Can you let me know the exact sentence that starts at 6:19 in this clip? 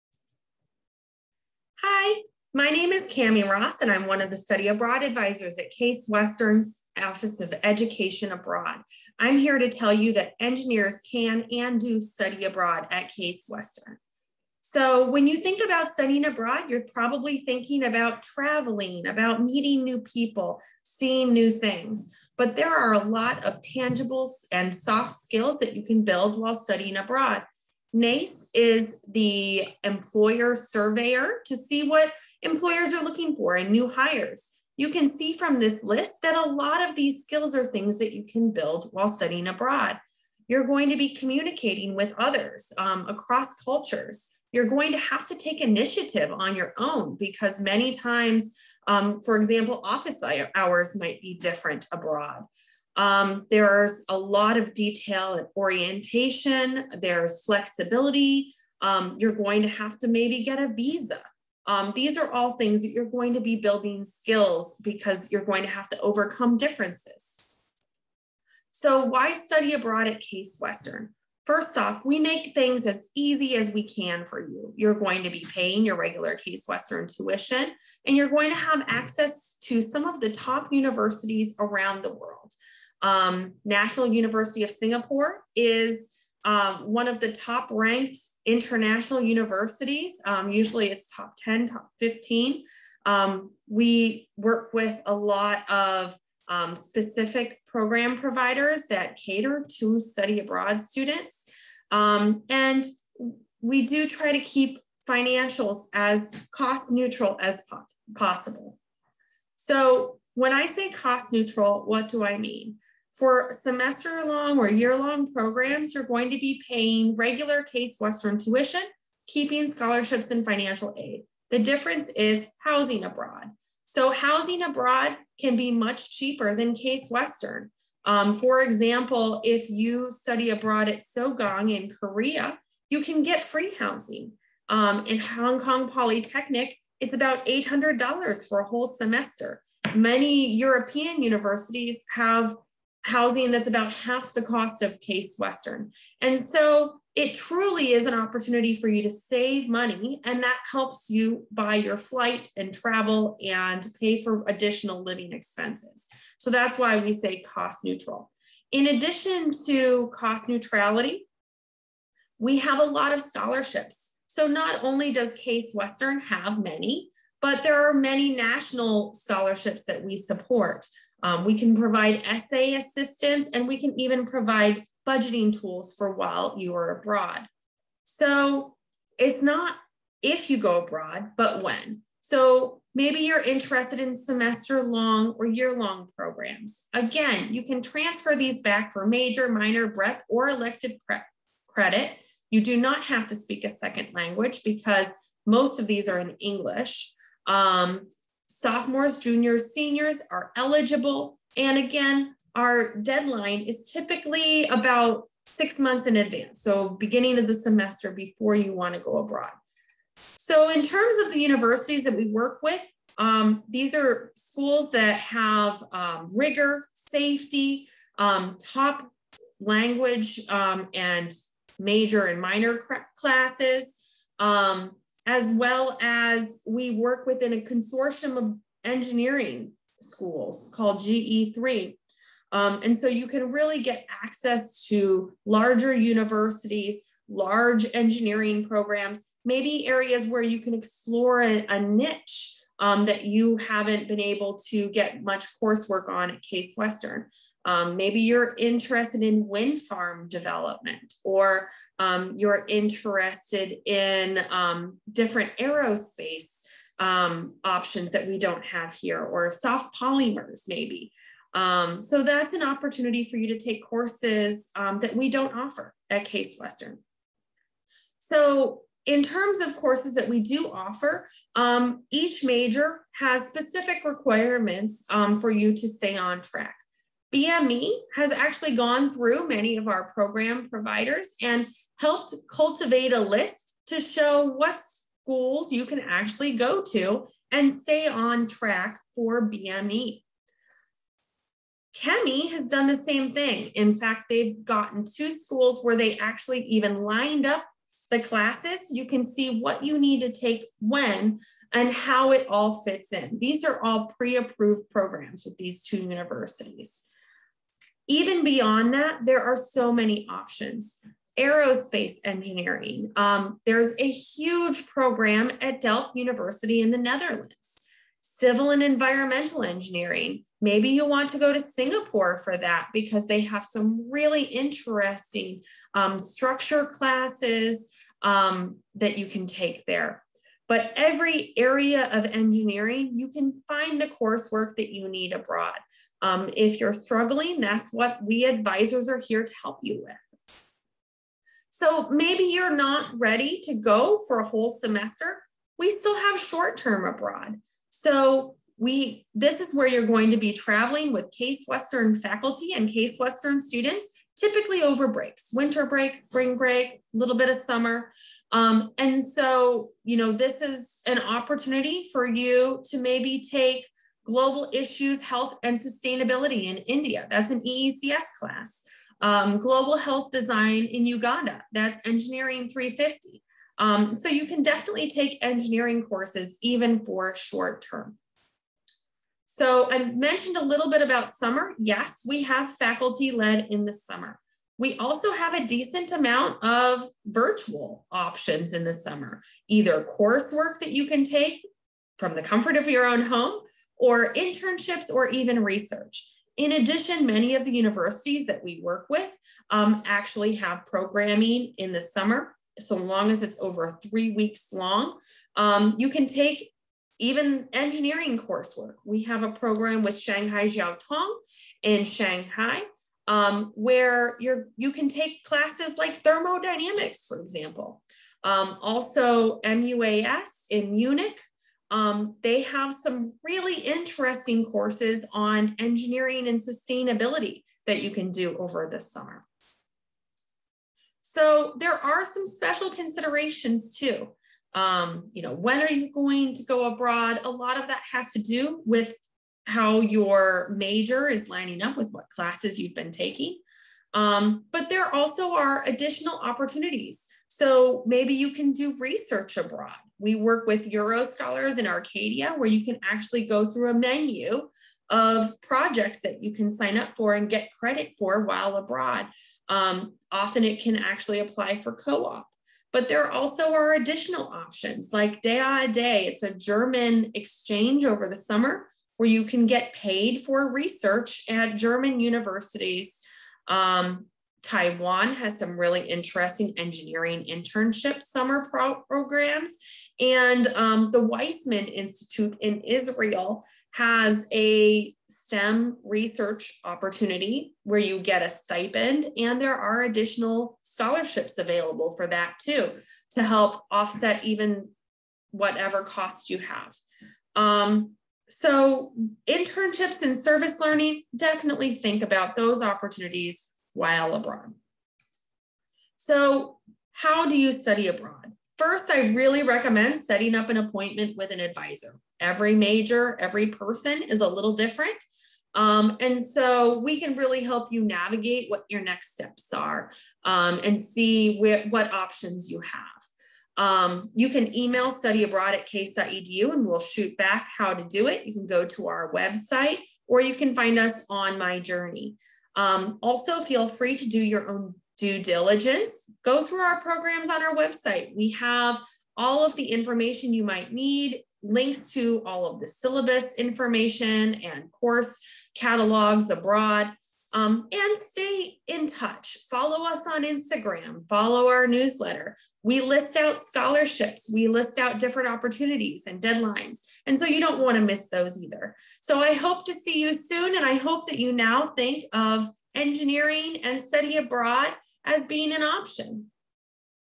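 So I mentioned a little bit about summer.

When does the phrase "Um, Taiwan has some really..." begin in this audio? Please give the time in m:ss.
7:53.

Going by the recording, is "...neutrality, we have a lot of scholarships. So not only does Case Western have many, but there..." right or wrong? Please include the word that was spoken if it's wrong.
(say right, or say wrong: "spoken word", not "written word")
right.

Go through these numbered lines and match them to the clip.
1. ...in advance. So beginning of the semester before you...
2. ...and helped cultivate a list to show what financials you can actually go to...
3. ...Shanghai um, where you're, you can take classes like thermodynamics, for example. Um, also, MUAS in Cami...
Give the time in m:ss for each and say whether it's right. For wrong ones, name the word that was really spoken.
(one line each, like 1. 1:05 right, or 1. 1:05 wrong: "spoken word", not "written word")
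1. 3:26 right
2. 4:41 wrong: "schools", not "financials"
3. 6:52 wrong: "Munich", not "Cami".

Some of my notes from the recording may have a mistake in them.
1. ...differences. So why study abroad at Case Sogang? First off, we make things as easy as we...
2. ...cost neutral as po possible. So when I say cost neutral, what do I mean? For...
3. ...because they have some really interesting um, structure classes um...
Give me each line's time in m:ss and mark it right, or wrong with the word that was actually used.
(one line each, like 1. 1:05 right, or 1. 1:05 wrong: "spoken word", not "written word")
1. 1:06 wrong: "Western", not "Sogang"
2. 1:46 right
3. 5:22 right.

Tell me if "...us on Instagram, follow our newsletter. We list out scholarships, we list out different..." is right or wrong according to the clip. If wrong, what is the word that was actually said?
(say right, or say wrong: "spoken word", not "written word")
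right.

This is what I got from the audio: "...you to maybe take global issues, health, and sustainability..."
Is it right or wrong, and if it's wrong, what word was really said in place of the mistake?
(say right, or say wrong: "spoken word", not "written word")
right.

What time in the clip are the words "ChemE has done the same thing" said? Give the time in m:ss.
4:51.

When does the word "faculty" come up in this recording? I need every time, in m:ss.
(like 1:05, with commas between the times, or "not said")
5:52, 6:22.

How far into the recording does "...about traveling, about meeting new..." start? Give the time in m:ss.
0:17.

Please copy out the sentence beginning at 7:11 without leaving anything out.
So there are some special considerations too.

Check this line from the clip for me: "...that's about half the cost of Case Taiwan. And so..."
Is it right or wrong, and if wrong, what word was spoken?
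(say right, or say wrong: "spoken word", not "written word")
wrong: "Western", not "Taiwan".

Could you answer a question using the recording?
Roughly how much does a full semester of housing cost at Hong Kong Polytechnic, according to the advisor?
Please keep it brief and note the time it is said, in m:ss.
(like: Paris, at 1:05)
$800, at 2:17.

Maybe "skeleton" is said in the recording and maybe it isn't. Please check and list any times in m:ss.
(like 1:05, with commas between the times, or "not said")
not said.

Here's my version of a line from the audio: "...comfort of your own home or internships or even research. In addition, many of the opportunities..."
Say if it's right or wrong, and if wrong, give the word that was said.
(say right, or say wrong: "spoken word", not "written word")
wrong: "universities", not "opportunities".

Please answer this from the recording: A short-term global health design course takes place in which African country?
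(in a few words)
Uganda.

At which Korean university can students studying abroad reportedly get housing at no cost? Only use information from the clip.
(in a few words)
Sogang.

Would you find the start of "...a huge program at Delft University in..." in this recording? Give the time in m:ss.
5:13.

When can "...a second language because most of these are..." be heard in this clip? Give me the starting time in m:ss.
3:13.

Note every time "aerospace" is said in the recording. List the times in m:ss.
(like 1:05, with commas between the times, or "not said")
4:15, 5:11.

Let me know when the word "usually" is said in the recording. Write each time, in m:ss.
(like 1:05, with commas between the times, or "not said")
1:30.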